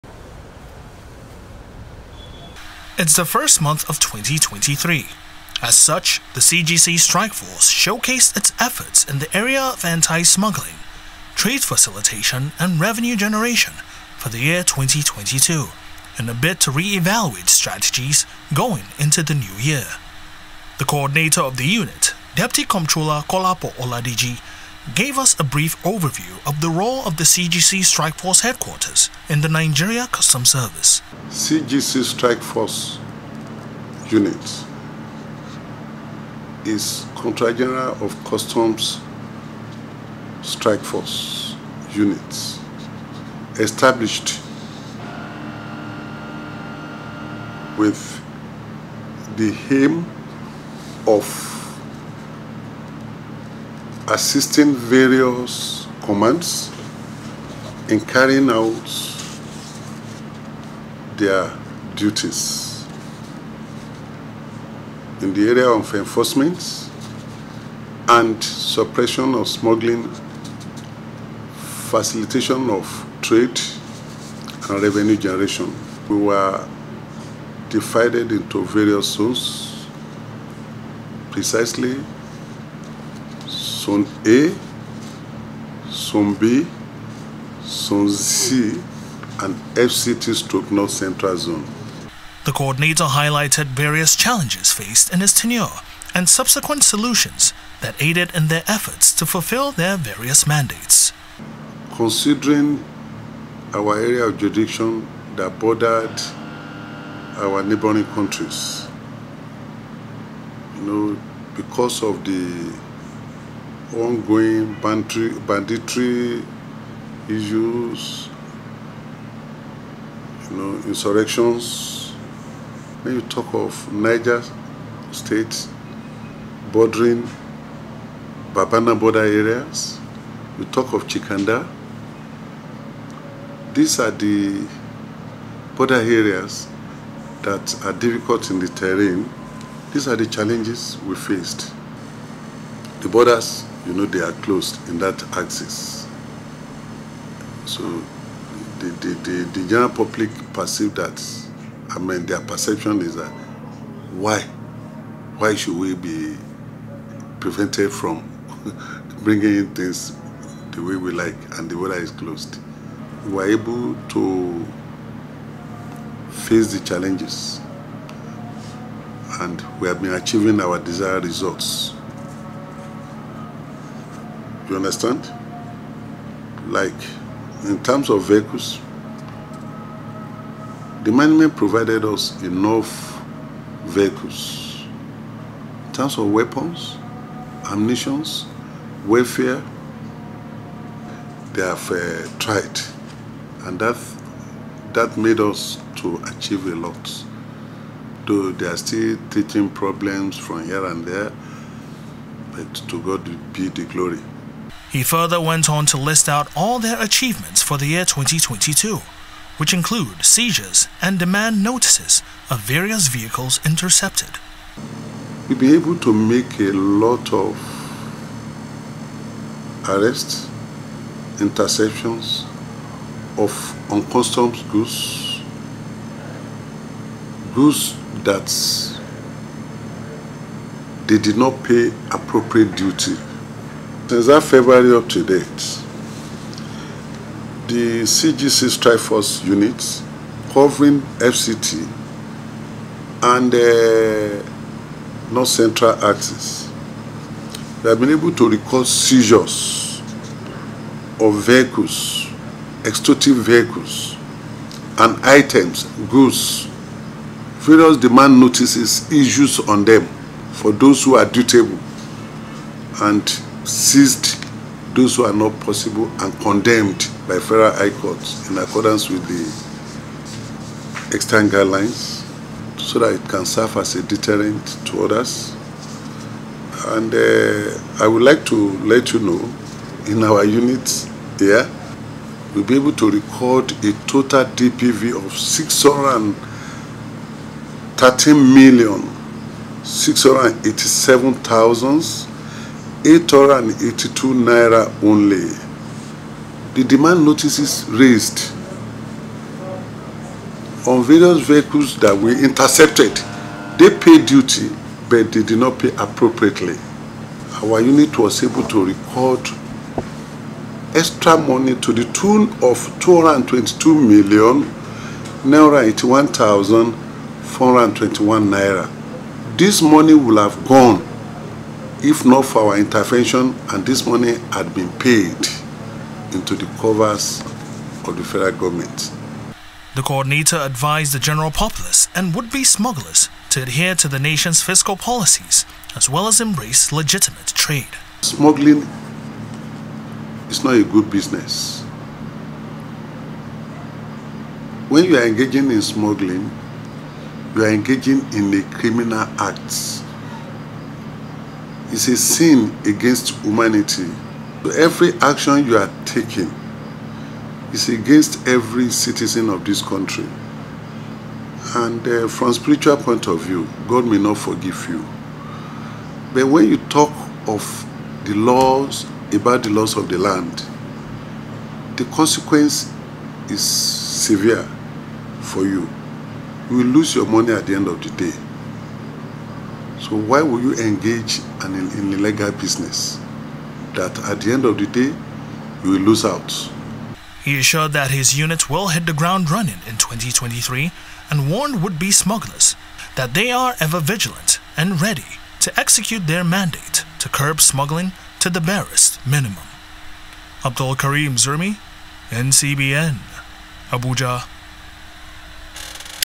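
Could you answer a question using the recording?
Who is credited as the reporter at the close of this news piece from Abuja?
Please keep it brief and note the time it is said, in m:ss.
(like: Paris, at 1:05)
Abdul Karim Zermi, at 6:40.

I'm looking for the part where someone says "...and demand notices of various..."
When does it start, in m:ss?
3:31.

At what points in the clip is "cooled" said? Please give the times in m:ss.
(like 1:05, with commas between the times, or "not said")
not said.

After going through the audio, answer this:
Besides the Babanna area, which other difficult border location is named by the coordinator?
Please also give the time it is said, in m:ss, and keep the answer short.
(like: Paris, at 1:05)
Chikanda, at 2:11.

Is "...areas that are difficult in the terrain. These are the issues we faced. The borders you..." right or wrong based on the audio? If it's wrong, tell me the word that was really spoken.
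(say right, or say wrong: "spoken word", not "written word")
wrong: "challenges", not "issues".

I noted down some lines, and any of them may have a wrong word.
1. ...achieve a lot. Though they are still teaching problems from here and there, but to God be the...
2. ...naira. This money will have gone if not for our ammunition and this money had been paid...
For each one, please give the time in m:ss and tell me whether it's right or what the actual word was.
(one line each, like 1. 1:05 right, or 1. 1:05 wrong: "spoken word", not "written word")
1. 3:16 right
2. 5:18 wrong: "intervention", not "ammunition".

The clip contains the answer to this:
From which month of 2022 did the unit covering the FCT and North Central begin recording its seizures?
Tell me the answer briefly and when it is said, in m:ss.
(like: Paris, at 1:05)
February, at 3:54.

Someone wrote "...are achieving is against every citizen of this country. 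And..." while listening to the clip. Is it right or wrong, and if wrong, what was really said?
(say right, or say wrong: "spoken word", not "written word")
wrong: "taking", not "achieving".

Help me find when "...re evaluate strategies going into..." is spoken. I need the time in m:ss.
0:16.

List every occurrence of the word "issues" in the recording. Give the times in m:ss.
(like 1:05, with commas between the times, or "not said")
1:57, 4:19.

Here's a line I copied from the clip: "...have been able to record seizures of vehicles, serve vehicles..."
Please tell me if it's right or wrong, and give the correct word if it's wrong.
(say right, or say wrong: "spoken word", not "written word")
wrong: "extortive", not "serve".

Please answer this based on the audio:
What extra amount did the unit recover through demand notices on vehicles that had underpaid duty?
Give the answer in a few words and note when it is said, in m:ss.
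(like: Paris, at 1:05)
222,081,421 naira, at 5:12.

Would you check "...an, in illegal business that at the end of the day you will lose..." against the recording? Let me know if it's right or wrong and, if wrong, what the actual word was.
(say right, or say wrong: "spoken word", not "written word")
right.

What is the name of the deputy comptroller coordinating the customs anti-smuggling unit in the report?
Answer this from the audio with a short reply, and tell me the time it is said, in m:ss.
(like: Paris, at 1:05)
Kolapo Oladeji, at 0:23.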